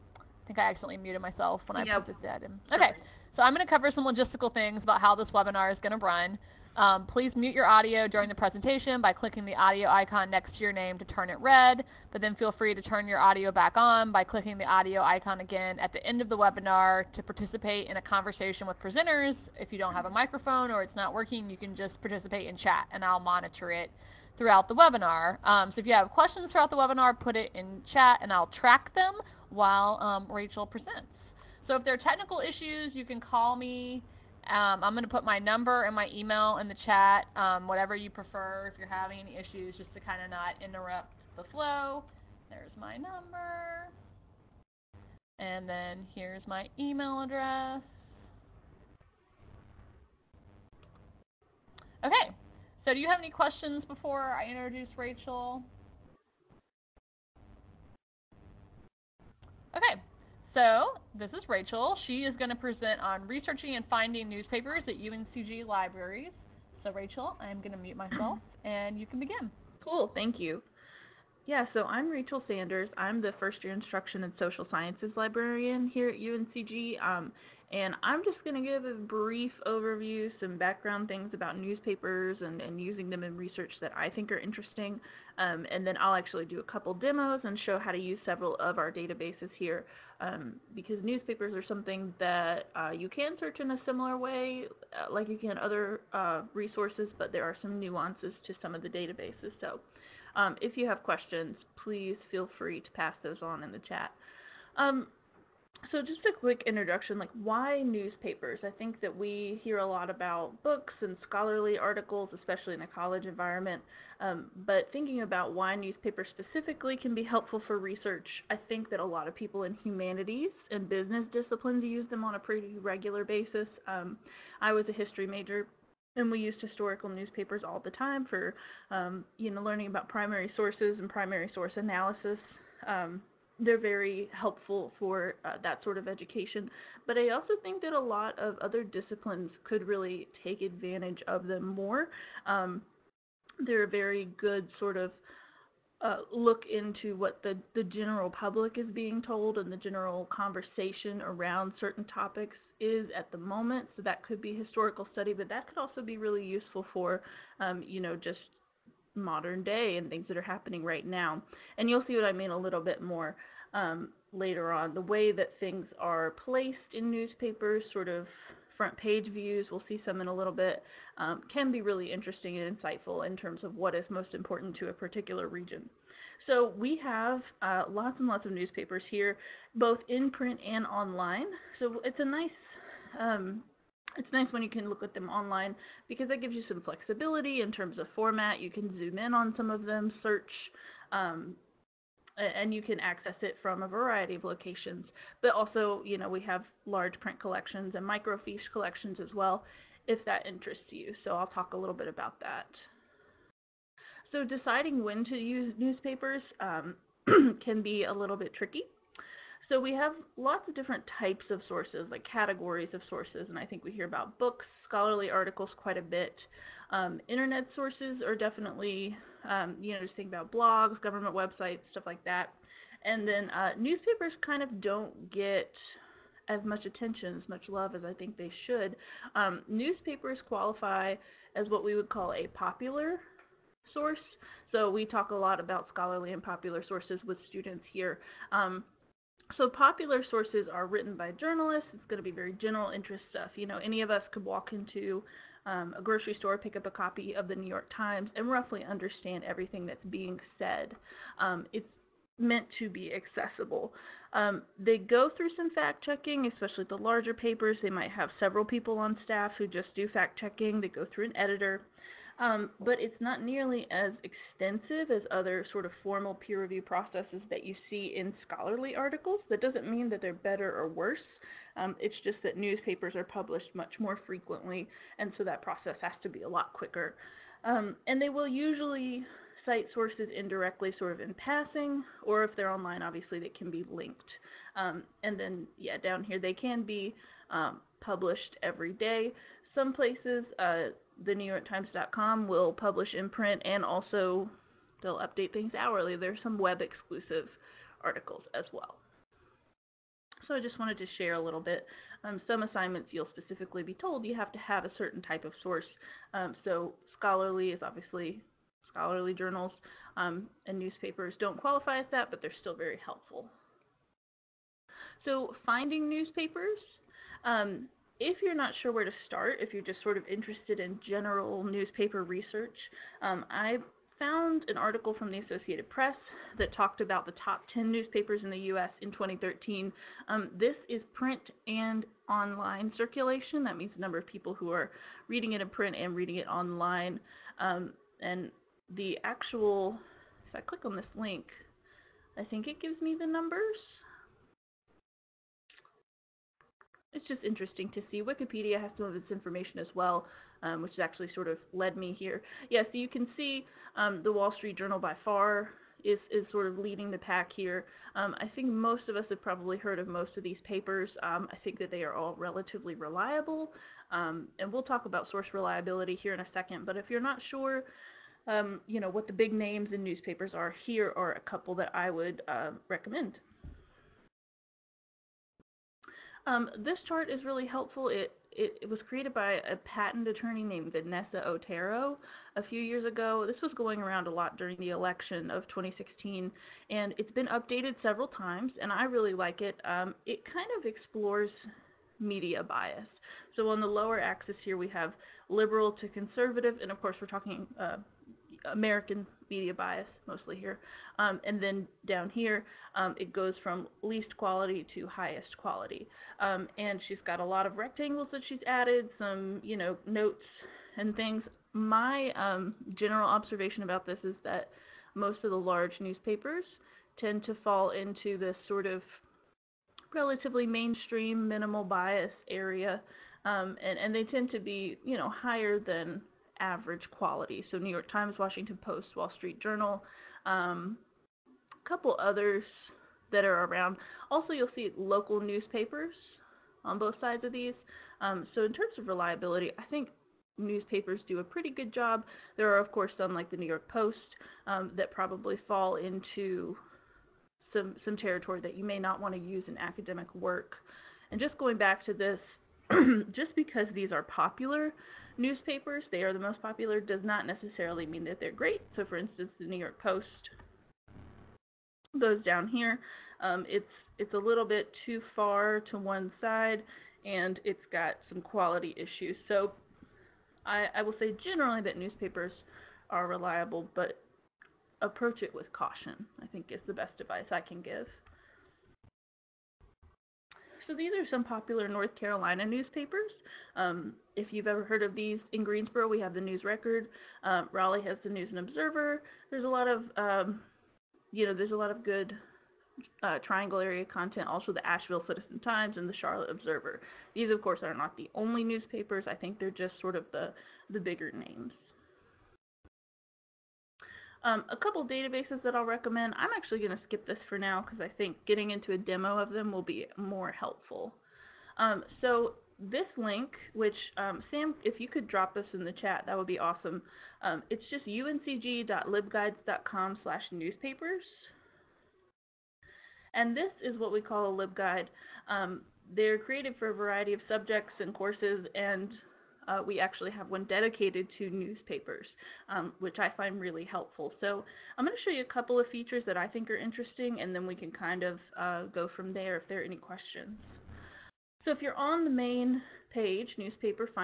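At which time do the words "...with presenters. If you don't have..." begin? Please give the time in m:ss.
0:18.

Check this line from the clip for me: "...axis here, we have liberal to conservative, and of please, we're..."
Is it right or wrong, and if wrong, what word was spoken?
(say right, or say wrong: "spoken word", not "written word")
wrong: "course", not "please".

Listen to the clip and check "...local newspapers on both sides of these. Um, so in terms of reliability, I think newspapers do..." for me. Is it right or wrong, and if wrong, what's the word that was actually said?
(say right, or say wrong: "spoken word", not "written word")
right.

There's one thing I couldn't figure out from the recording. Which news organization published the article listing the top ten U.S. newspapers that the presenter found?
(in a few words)
Associated Press.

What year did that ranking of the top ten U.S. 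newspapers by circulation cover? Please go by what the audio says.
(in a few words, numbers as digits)
2013.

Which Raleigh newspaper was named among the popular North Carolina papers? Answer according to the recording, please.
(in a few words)
News and Observer.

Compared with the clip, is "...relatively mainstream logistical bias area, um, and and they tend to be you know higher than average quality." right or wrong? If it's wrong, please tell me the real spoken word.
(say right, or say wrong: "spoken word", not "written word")
wrong: "minimal", not "logistical".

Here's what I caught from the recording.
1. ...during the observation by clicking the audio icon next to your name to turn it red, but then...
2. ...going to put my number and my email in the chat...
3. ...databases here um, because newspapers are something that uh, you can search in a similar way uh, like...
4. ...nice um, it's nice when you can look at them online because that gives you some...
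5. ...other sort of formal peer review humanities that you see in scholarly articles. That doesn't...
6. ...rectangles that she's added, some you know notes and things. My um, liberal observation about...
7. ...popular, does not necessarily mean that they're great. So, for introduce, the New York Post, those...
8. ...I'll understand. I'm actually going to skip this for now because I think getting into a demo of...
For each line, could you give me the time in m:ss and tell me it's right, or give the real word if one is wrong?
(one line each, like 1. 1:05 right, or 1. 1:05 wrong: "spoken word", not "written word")
1. 0:08 wrong: "presentation", not "observation"
2. 0:34 right
3. 1:28 right
4. 3:02 right
5. 4:25 wrong: "processes", not "humanities"
6. 6:47 wrong: "general", not "liberal"
7. 7:36 wrong: "instance", not "introduce"
8. 8:25 wrong: "recommend", not "understand".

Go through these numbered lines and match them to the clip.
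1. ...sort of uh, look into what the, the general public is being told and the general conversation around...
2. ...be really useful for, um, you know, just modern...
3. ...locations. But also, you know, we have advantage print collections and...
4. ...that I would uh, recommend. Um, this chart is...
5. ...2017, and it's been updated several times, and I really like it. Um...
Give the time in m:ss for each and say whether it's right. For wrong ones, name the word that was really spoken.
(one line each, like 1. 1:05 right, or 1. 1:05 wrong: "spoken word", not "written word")
1. 2:24 right
2. 2:36 right
3. 3:14 wrong: "large", not "advantage"
4. 6:11 right
5. 6:25 wrong: "2016", not "2017".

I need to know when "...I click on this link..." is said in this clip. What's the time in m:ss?
5:40.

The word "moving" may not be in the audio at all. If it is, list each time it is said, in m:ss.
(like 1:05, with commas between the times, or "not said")
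not said.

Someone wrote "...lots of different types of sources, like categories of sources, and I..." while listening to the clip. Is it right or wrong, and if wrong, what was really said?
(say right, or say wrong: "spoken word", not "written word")
right.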